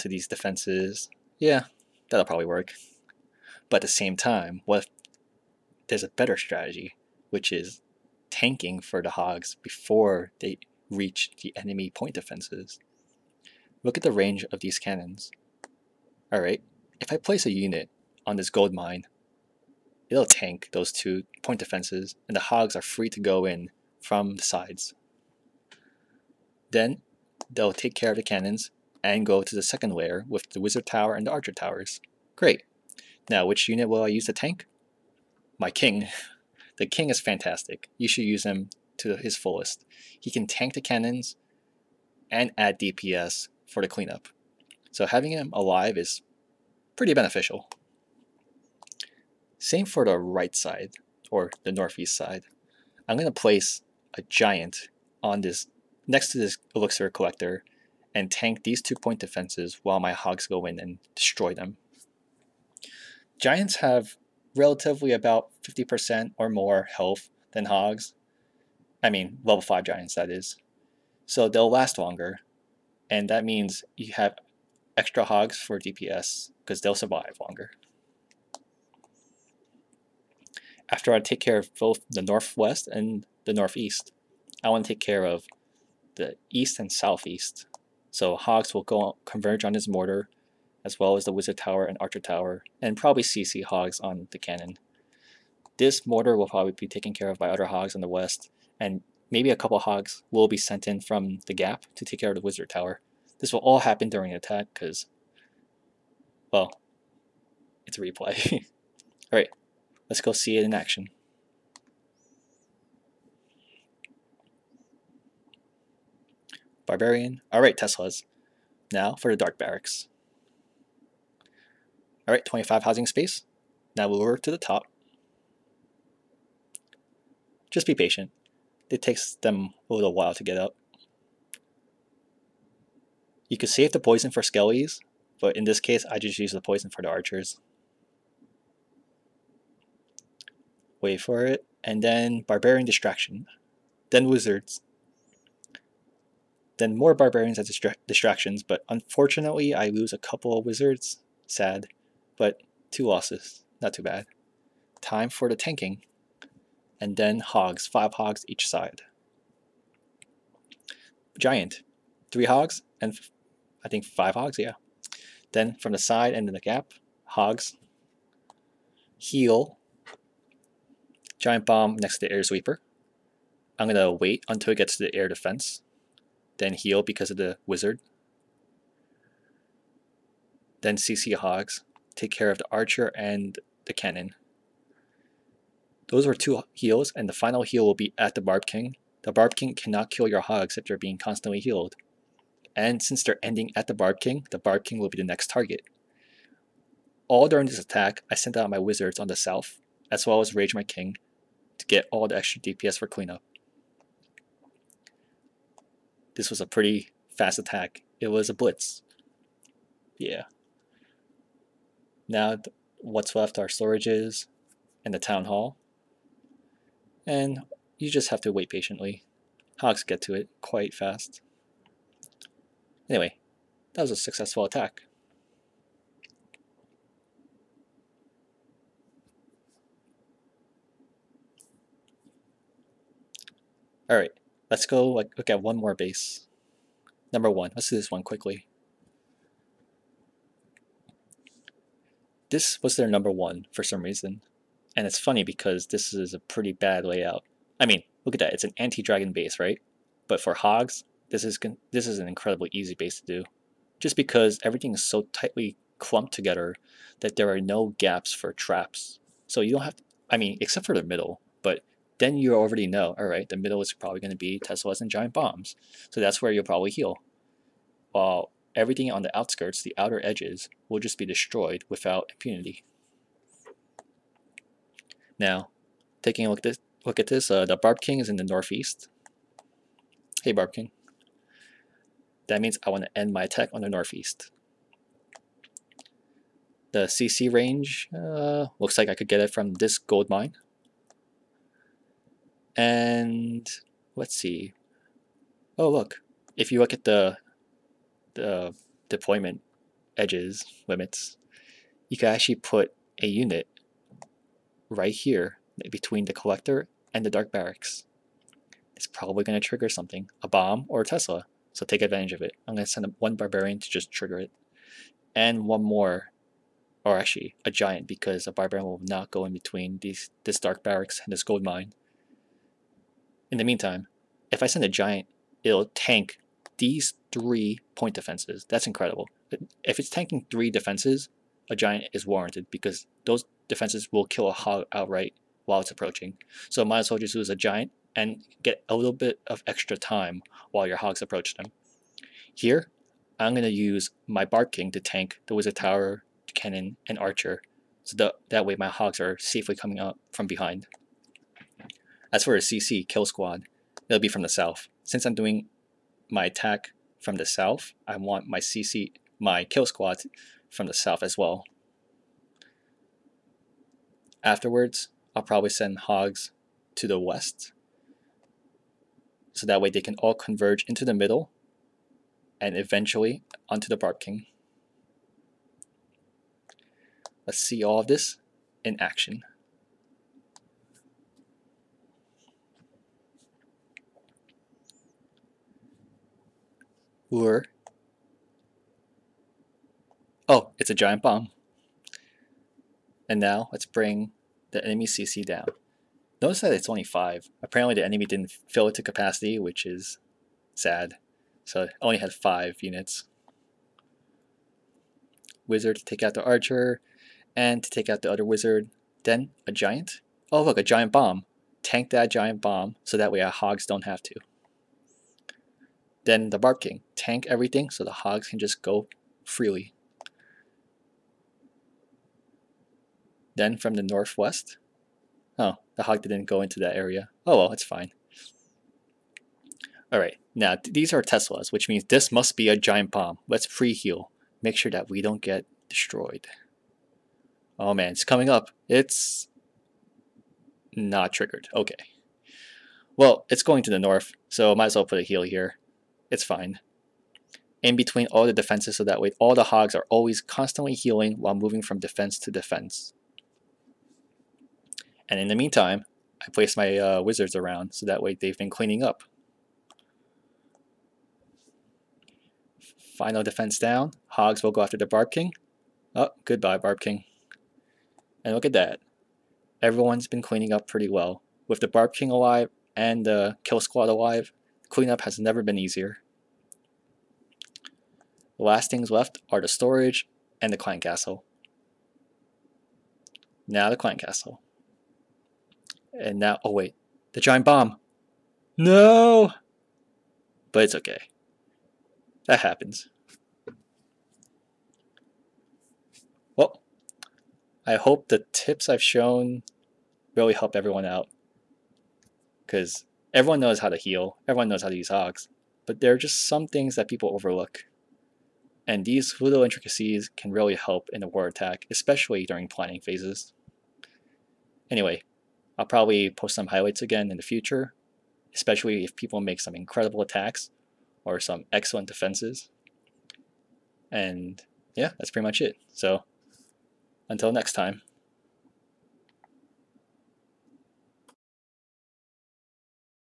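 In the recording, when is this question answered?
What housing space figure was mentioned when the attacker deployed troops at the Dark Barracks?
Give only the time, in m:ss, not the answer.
2:02.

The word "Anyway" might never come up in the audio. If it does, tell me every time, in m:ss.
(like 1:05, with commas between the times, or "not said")
3:43, 8:34.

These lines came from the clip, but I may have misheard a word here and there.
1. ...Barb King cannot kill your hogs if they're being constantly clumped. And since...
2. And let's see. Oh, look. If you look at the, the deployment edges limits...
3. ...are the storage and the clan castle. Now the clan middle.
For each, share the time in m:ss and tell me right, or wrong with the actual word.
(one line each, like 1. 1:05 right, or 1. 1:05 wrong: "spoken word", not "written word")
1. 3:09 wrong: "healed", not "clumped"
2. 4:52 right
3. 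7:59 wrong: "castle", not "middle".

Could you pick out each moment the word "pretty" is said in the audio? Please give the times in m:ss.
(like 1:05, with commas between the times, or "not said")
0:46, 3:26, 4:06, 7:50, 8:45.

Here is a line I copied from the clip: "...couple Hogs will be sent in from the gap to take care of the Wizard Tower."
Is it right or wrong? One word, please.
right.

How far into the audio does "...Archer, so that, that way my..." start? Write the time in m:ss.
5:47.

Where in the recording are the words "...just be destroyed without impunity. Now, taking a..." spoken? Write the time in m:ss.
4:31.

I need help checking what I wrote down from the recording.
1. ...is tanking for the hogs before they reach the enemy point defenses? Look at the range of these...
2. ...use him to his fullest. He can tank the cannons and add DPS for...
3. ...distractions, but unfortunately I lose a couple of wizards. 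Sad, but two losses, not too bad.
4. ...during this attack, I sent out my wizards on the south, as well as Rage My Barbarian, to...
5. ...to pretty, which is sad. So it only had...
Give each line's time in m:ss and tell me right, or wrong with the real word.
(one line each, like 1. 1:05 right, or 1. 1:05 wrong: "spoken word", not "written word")
1. 0:07 right
2. 0:38 right
3. 2:28 right
4. 3:17 wrong: "King", not "Barbarian"
5. 6:38 wrong: "capacity", not "pretty".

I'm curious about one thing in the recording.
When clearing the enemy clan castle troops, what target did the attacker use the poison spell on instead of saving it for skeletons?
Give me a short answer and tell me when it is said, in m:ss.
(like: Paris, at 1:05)
archers, at 2:17.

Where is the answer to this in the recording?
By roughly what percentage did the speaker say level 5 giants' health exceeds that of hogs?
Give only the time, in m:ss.
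1:05.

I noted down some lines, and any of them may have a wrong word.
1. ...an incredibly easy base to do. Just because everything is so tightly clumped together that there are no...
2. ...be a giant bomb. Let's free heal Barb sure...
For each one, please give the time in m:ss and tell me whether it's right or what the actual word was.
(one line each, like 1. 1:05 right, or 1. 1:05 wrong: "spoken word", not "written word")
1. 4:12 right
2. 7:12 wrong: "Make", not "Barb".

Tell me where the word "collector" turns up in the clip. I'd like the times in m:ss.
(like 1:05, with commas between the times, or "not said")
0:57, 5:06.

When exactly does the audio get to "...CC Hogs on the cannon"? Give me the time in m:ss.
1:33.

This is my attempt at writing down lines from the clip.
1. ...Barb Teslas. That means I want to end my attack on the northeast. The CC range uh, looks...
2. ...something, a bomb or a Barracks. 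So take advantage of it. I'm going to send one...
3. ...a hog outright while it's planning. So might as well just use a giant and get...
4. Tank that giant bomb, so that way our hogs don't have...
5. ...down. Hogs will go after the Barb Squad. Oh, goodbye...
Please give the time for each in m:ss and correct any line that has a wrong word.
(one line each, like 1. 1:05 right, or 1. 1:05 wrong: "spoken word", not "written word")
1. 4:40 wrong: "King", not "Teslas"
2. 5:09 wrong: "Tesla", not "Barracks"
3. 5:34 wrong: "approaching", not "planning"
4. 6:51 right
5. 7:43 wrong: "King", not "Squad".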